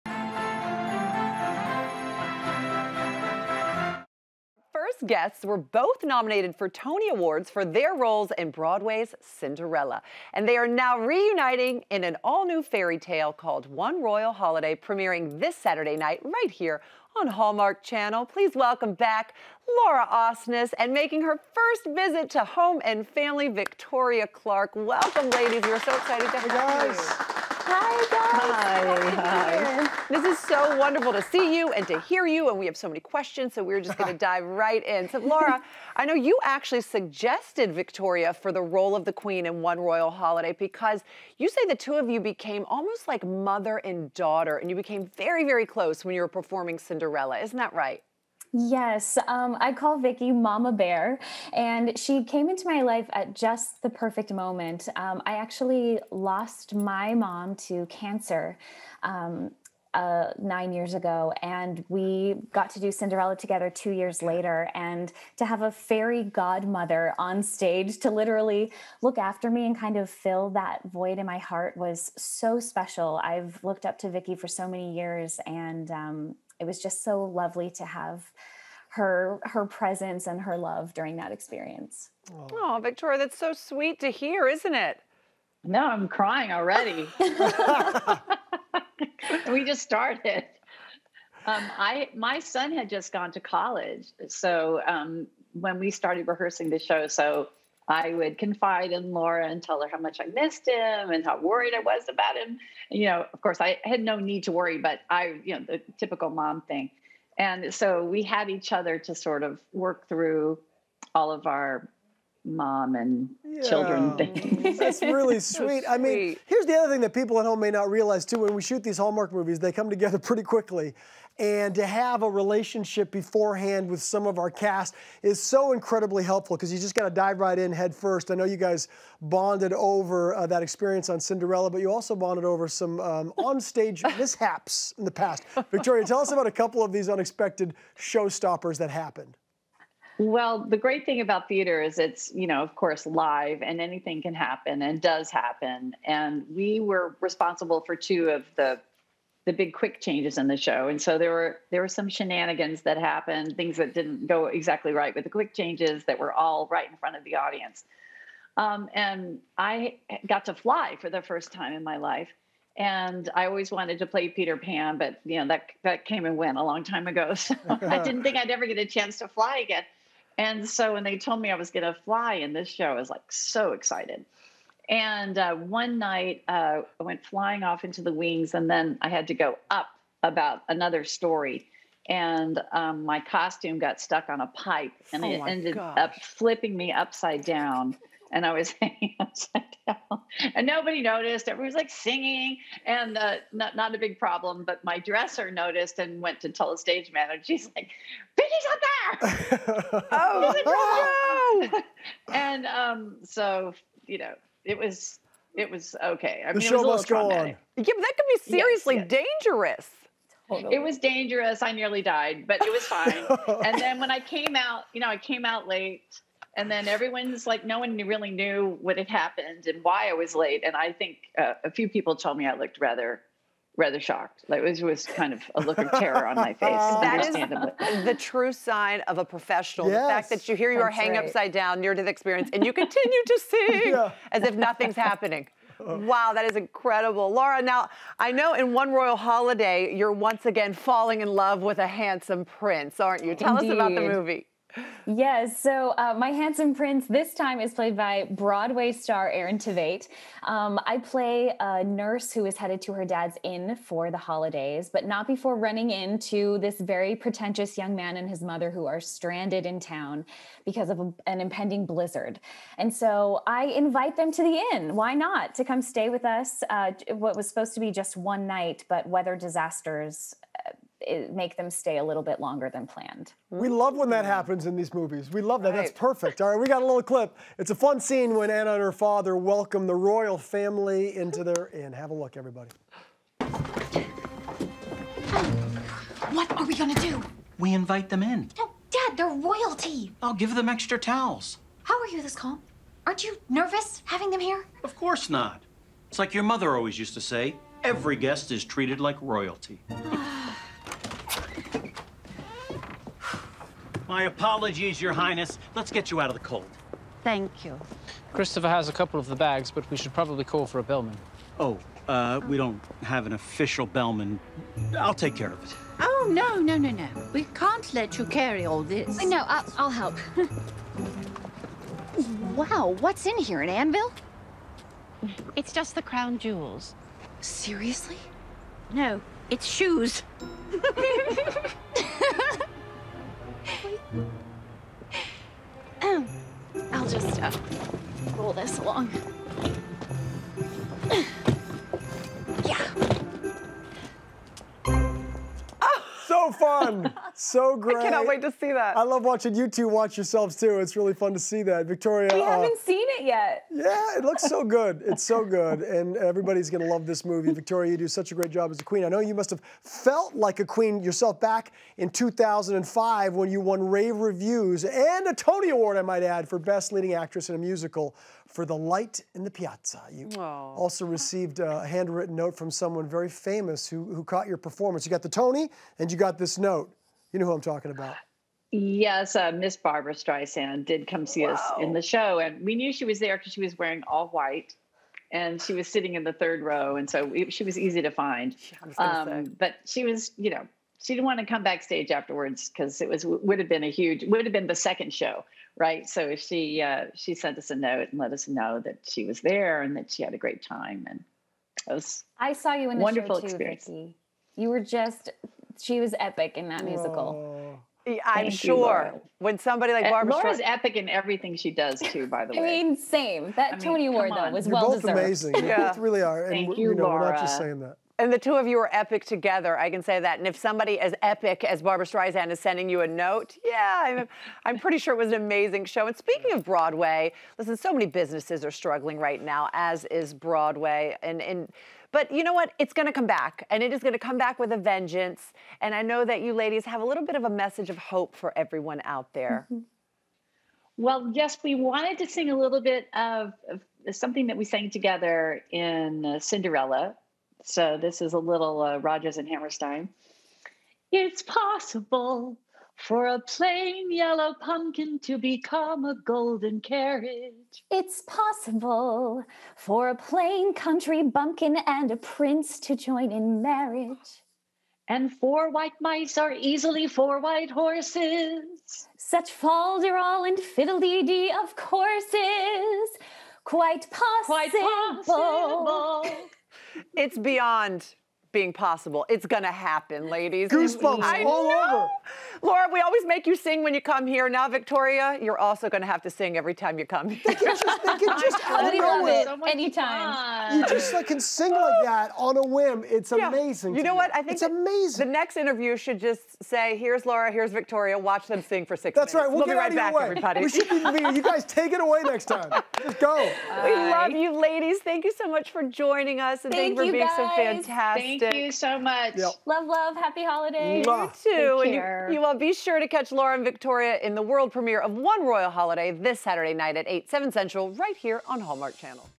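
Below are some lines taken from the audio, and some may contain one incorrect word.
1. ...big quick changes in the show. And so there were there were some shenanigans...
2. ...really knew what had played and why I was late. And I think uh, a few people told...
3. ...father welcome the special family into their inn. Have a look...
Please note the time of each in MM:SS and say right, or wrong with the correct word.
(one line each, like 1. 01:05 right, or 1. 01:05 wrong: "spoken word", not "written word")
1. 02:29 right
2. 03:37 wrong: "happened", not "played"
3. 04:38 wrong: "royal", not "special".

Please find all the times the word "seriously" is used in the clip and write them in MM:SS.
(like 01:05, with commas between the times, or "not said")
03:28, 05:27.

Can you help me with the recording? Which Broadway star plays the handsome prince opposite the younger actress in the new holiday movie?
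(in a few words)
Aaron Tveit.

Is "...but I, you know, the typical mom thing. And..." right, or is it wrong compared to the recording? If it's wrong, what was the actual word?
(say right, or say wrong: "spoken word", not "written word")
right.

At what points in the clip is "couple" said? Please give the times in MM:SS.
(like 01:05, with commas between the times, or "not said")
02:16, 05:08.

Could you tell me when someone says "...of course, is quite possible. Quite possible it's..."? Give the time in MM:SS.
07:51.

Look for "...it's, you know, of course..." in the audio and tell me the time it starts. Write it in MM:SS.
02:21.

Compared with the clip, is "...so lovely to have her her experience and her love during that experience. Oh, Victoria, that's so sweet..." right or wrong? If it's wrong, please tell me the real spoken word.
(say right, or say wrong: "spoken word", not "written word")
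wrong: "presence", not "experience".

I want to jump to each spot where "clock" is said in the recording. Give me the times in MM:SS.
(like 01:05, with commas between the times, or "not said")
not said.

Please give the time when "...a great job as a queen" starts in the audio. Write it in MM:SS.
05:58.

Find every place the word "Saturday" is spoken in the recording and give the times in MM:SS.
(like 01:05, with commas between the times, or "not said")
00:15, 08:36.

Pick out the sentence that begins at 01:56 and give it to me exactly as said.
here's the other thing that people at home may not realize too.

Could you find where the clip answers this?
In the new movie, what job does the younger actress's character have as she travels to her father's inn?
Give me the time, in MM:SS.
04:11.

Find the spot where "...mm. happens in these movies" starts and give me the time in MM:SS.
04:34.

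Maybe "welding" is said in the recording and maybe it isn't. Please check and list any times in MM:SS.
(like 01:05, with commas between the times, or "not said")
not said.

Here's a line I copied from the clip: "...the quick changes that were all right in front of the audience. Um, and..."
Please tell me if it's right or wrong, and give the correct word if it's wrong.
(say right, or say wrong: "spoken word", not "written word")
right.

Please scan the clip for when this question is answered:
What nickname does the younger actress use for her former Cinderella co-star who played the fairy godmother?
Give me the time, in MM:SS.
00:50.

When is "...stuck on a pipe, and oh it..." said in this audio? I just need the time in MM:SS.
03:04.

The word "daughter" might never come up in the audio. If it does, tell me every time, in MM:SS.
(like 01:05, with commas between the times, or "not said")
00:44.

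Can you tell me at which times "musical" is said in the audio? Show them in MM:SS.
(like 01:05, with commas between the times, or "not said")
06:07, 06:46.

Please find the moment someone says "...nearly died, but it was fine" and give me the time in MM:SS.
03:31.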